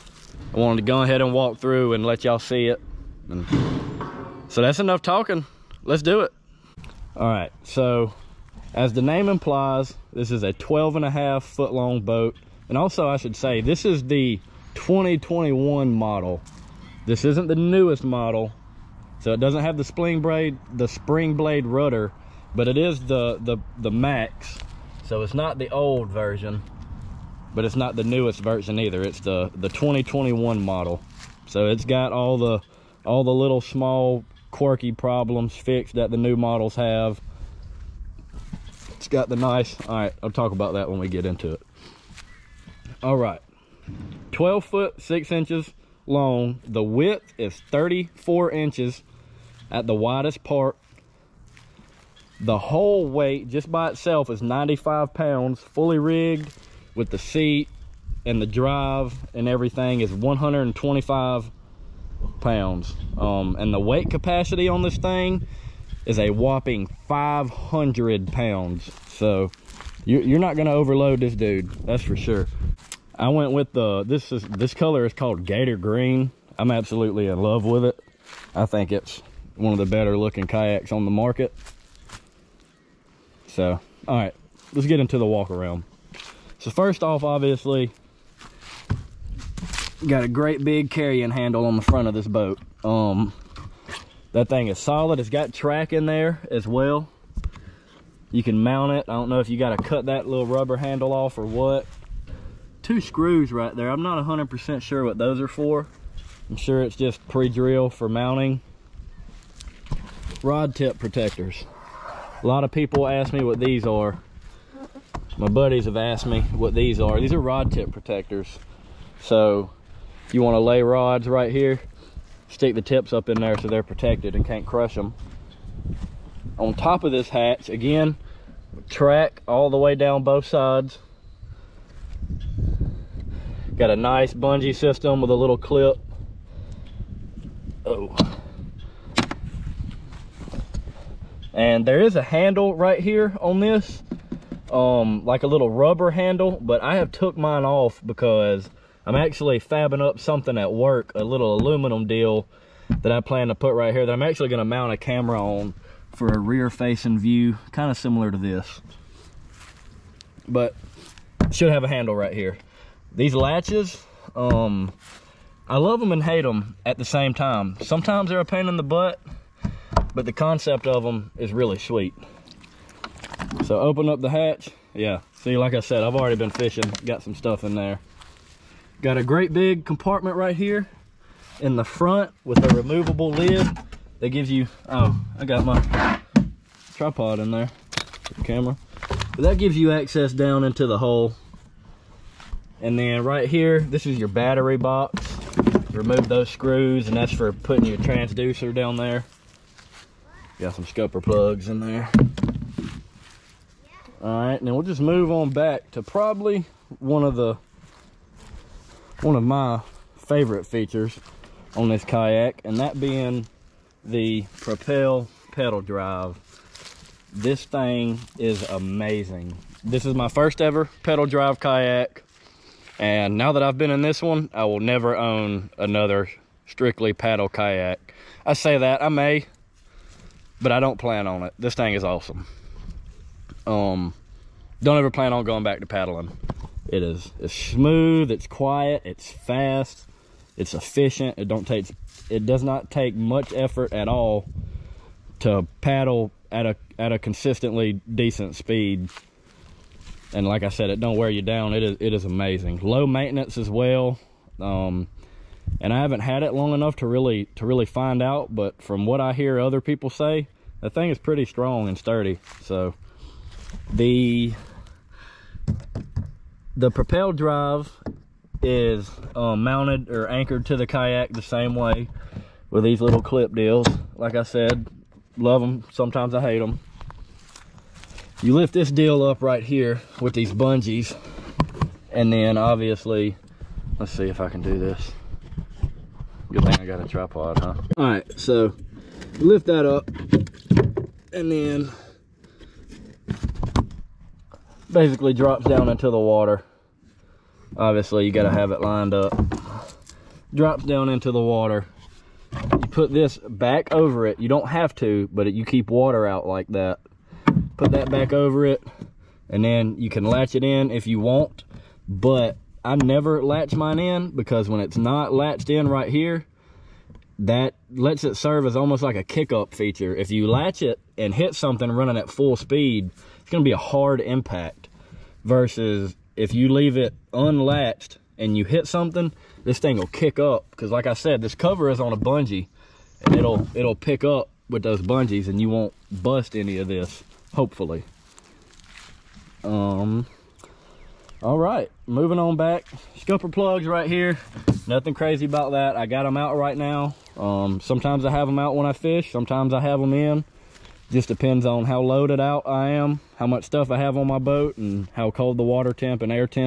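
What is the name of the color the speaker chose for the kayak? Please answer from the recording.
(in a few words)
Gator Green.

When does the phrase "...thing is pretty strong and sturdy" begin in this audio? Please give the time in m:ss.
4:20.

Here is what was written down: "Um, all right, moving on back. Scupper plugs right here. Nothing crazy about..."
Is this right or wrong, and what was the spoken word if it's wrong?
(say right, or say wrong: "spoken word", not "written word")
right.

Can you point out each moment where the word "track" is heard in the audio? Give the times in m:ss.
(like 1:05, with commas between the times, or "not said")
1:35, 2:08.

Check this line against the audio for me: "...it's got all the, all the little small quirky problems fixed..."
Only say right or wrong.
right.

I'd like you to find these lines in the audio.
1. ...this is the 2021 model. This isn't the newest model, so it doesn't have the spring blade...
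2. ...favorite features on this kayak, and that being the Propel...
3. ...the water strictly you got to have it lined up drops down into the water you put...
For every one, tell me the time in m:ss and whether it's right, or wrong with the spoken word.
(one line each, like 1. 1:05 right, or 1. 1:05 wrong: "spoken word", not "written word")
1. 0:13 right
2. 3:30 right
3. 4:56 wrong: "obviously", not "strictly".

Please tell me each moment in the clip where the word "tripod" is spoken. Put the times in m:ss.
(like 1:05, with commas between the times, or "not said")
3:06, 4:47.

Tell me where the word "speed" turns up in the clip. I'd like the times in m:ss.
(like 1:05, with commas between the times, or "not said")
4:08, 5:22.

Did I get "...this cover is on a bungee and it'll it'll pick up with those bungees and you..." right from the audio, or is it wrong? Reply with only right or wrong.
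right.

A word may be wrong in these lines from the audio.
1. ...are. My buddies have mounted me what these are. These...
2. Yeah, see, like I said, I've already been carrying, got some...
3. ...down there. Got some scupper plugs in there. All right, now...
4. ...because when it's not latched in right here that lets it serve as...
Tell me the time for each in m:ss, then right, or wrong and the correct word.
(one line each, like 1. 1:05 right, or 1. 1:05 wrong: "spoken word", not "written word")
1. 1:53 wrong: "asked", not "mounted"
2. 2:54 wrong: "fishing", not "carrying"
3. 3:18 right
4. 5:14 right.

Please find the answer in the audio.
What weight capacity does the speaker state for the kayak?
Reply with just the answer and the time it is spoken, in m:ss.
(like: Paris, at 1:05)
500 pounds, at 1:07.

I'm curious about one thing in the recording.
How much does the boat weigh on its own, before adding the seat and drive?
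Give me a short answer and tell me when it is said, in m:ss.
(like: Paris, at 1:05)
95 pounds, at 0:54.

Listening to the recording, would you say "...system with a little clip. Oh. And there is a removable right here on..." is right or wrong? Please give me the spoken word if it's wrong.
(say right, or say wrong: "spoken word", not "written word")
wrong: "handle", not "removable".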